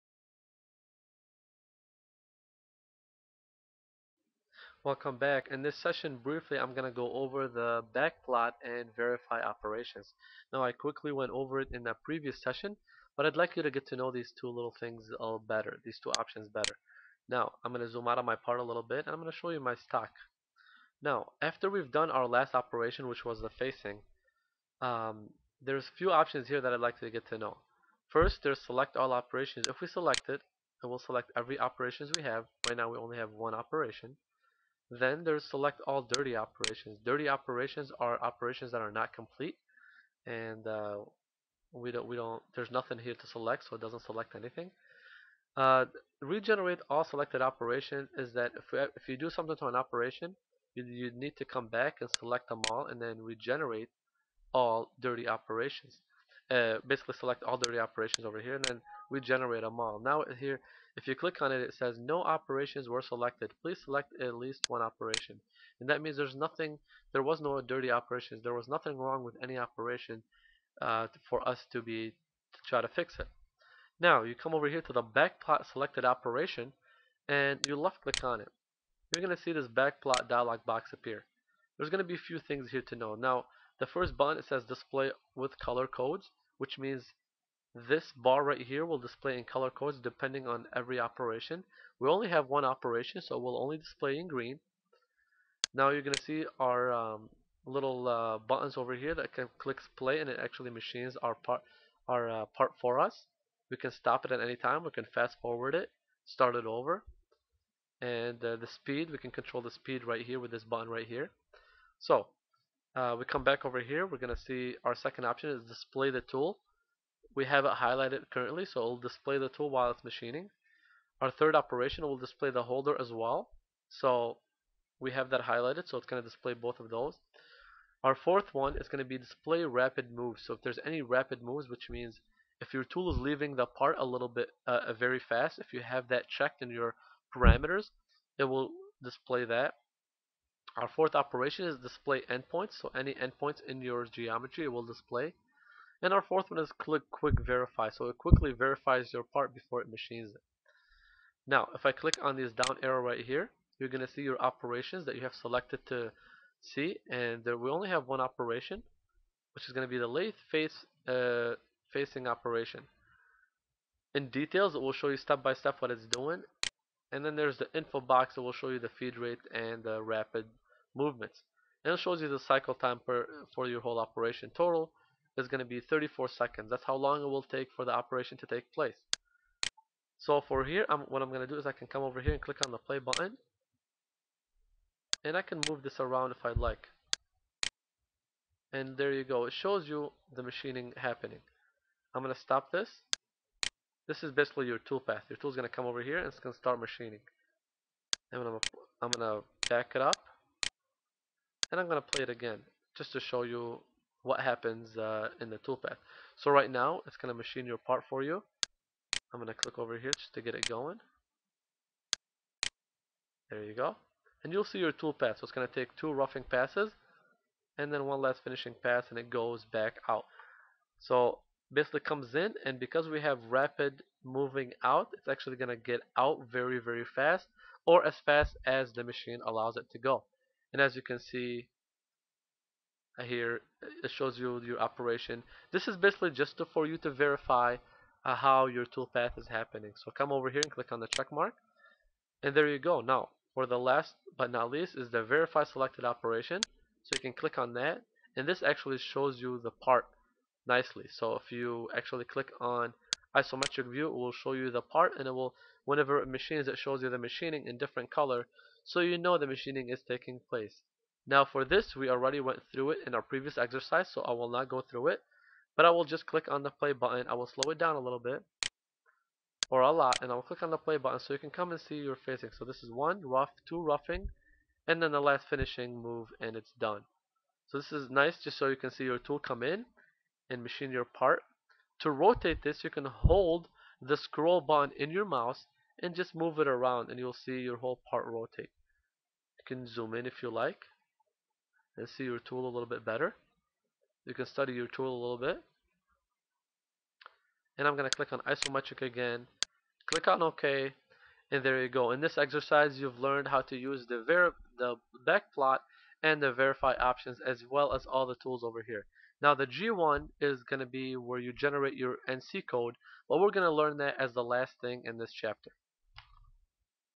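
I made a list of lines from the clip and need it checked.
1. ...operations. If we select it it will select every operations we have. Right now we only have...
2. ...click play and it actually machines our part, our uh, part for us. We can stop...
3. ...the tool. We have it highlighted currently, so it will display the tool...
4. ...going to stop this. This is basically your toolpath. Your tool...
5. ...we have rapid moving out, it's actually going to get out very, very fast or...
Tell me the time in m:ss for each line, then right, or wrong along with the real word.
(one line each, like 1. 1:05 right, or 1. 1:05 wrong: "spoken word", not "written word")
1. 0:29 right
2. 1:39 right
3. 1:56 right
4. 3:12 right
5. 3:43 right.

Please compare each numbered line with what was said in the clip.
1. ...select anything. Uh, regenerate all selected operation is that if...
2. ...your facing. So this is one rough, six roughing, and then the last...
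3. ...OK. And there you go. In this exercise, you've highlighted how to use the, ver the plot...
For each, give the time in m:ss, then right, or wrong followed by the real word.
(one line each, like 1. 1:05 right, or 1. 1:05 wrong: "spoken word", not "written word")
1. 0:44 right
2. 4:31 wrong: "two", not "six"
3. 5:00 wrong: "learned", not "highlighted".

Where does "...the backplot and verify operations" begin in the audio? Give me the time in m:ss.
0:07.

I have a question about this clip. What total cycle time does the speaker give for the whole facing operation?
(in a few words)
34 seconds.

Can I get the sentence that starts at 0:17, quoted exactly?
Now I'm gonna zoom out of my part a little bit and I'm gonna show you my stock.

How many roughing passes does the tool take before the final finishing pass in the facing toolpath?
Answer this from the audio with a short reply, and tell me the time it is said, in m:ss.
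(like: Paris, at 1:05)
2, at 3:35.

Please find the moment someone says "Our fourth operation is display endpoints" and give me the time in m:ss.
2:20.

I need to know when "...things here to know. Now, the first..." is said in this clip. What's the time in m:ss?
1:22.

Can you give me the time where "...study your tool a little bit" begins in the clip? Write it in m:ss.
4:54.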